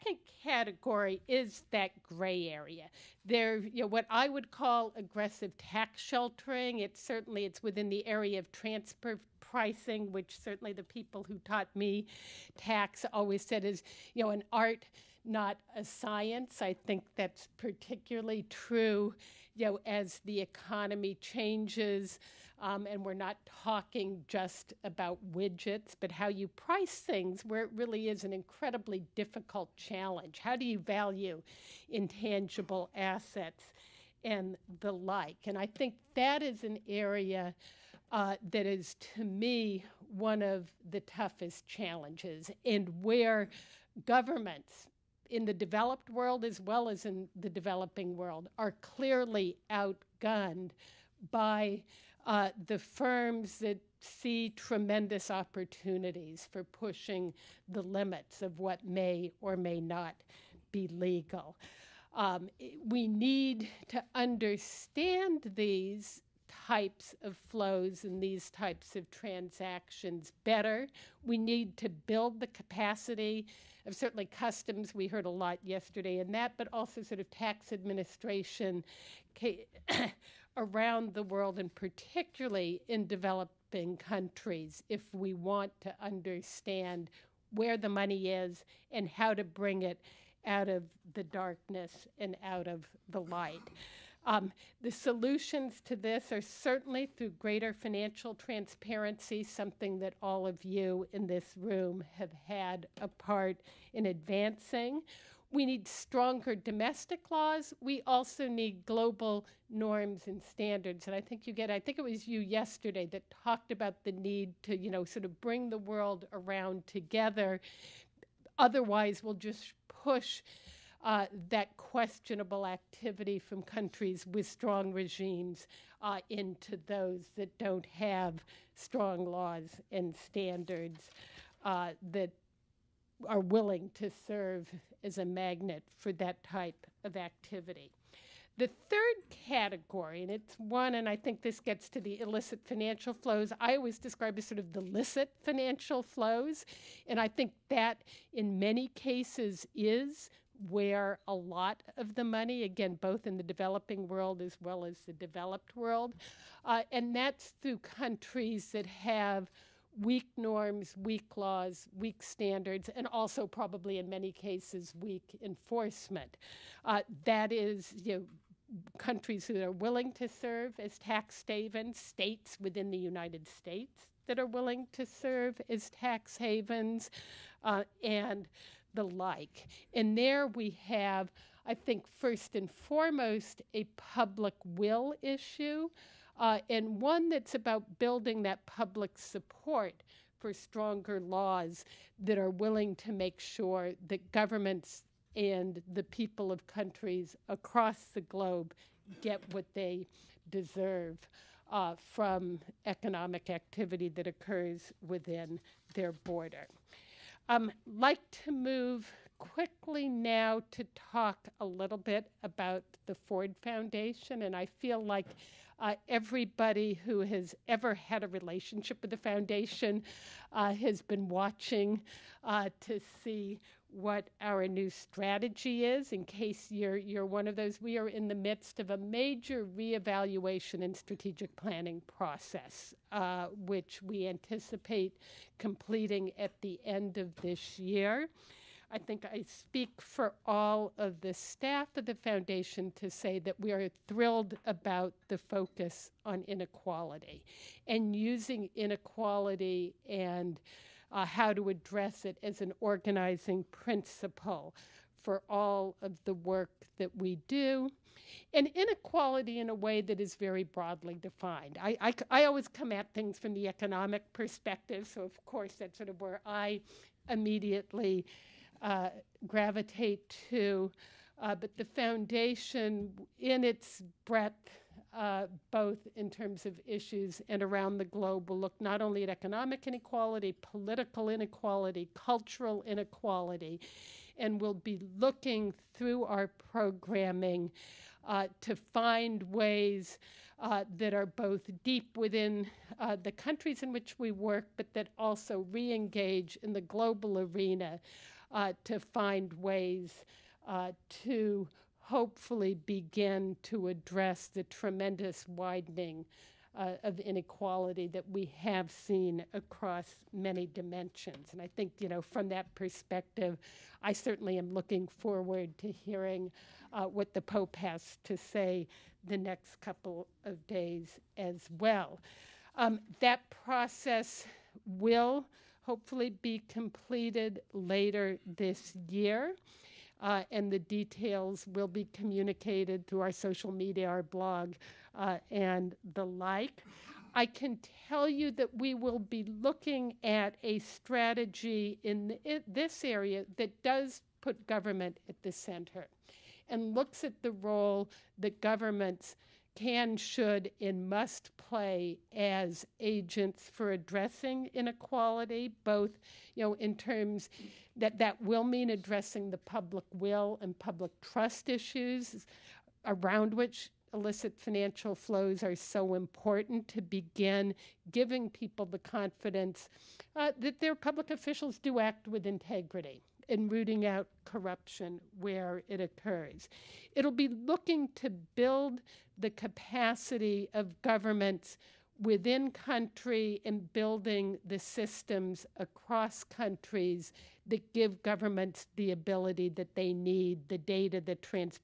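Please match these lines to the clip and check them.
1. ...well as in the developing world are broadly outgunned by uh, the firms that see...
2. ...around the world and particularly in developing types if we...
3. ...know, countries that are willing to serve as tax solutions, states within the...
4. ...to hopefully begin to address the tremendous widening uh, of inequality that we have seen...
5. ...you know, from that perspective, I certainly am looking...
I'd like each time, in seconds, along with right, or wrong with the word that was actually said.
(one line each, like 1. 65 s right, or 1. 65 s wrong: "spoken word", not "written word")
1. 46 s wrong: "clearly", not "broadly"
2. 80 s wrong: "countries", not "types"
3. 168 s wrong: "havens", not "solutions"
4. 301 s right
5. 311 s right.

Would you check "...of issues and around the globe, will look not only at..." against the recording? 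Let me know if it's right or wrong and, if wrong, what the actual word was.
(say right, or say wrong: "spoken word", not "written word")
right.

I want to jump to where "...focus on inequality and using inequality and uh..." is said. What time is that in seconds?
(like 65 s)
245 s.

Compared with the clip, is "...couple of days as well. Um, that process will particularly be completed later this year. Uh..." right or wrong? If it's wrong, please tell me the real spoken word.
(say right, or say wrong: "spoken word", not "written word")
wrong: "hopefully", not "particularly".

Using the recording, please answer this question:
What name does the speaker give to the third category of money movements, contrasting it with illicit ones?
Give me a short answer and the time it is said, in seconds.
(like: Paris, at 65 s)
licit financial flows, at 144 s.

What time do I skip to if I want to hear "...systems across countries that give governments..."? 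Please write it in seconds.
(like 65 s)
384 s.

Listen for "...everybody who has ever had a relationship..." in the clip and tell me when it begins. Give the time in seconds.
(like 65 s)
216 s.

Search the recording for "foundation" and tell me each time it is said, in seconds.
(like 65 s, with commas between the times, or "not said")
213 s, 219 s, 242 s, 271 s.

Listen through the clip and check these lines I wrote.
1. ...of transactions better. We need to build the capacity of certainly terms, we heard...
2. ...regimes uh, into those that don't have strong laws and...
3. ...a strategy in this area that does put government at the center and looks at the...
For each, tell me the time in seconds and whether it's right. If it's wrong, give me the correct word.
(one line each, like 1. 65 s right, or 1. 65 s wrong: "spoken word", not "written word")
1. 68 s wrong: "customs", not "terms"
2. 124 s right
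3. 340 s right.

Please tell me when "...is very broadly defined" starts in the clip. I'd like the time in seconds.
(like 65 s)
260 s.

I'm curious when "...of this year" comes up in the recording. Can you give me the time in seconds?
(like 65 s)
237 s.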